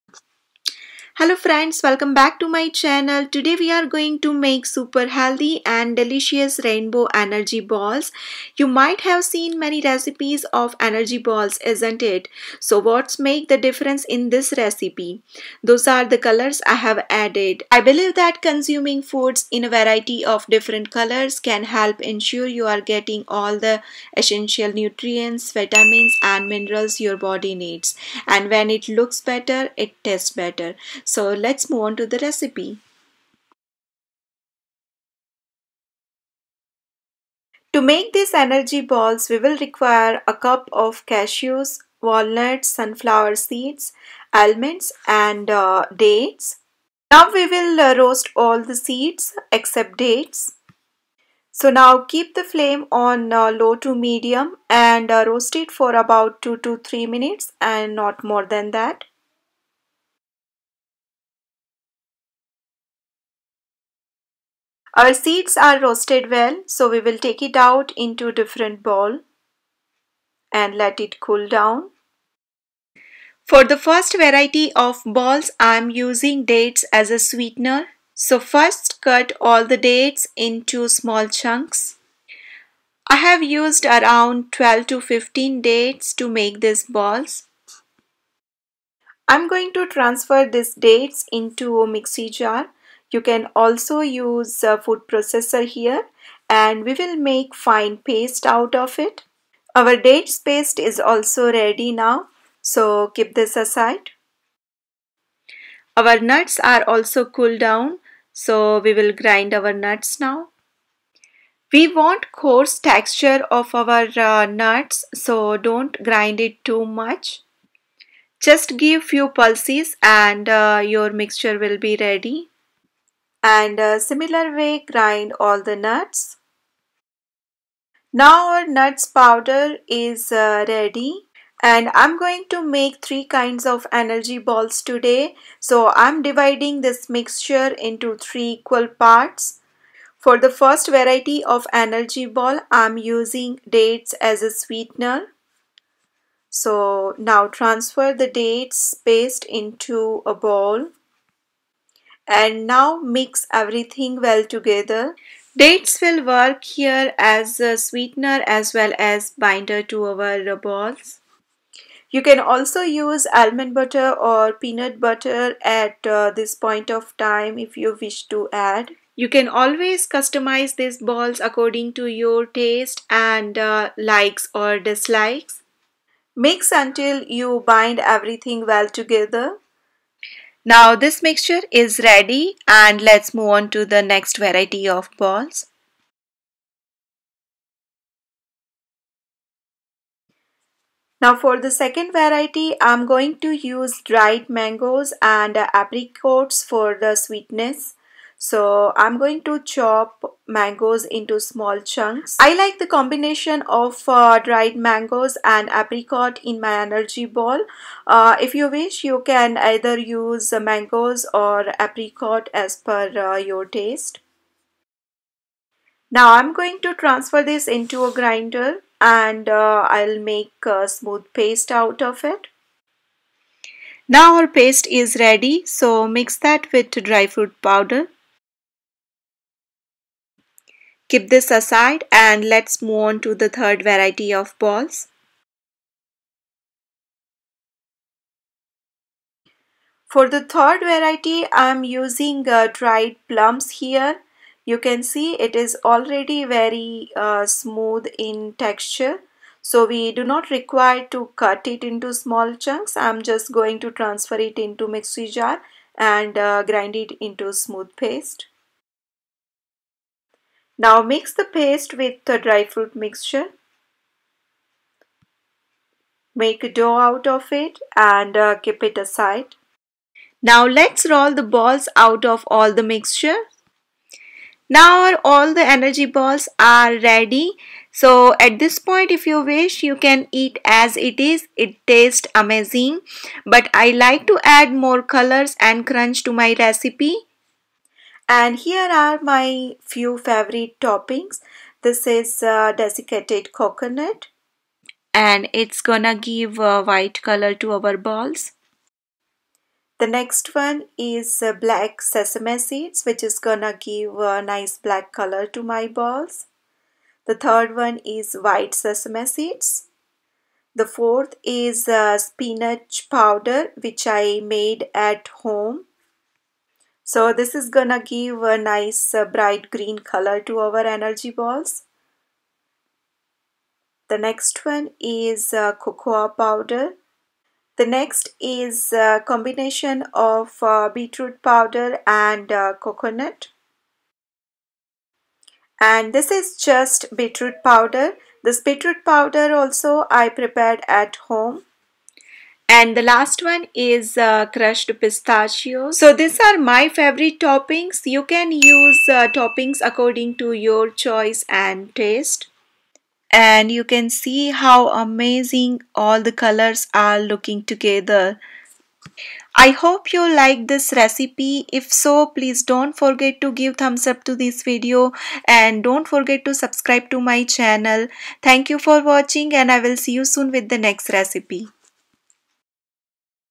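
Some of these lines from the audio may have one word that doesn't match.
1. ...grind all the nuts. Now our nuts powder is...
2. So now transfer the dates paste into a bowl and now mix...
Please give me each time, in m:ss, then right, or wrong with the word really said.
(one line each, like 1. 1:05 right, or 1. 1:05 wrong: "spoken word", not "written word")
1. 2:04 right
2. 2:26 right.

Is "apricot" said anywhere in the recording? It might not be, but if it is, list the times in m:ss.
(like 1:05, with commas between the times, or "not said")
3:15, 3:25, 3:31.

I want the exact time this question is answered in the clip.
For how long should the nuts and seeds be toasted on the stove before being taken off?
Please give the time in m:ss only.
0:56.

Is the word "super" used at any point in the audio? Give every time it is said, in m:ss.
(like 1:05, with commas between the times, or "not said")
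0:04.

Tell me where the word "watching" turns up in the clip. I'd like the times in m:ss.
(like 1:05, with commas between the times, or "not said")
6:09.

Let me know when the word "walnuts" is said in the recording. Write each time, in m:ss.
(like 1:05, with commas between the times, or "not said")
0:42.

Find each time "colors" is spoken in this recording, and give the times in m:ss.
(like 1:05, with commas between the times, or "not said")
0:16, 0:20, 4:45, 4:57, 5:05, 5:19, 5:56.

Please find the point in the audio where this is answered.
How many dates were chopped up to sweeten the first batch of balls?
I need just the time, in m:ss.
1:24.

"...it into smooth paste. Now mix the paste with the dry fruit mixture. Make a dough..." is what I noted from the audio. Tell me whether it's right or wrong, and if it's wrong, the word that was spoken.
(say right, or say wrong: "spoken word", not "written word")
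right.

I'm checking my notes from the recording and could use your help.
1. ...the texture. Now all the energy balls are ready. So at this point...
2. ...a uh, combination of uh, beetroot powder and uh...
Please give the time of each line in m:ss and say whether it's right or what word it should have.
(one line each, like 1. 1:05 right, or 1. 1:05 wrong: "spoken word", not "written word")
1. 4:32 wrong: "mixture", not "texture"
2. 5:28 right.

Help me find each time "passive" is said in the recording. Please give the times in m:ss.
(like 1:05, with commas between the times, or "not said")
not said.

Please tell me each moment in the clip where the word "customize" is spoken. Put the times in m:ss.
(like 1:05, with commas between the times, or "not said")
2:50.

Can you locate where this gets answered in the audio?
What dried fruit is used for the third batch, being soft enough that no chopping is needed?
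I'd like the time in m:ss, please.
4:02.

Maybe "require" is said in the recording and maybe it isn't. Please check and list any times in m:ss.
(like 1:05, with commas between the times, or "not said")
0:39, 4:10.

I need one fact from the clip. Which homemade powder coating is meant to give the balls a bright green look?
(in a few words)
Spinach powder.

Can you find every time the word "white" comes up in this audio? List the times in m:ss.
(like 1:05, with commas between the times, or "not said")
4:56, 5:08.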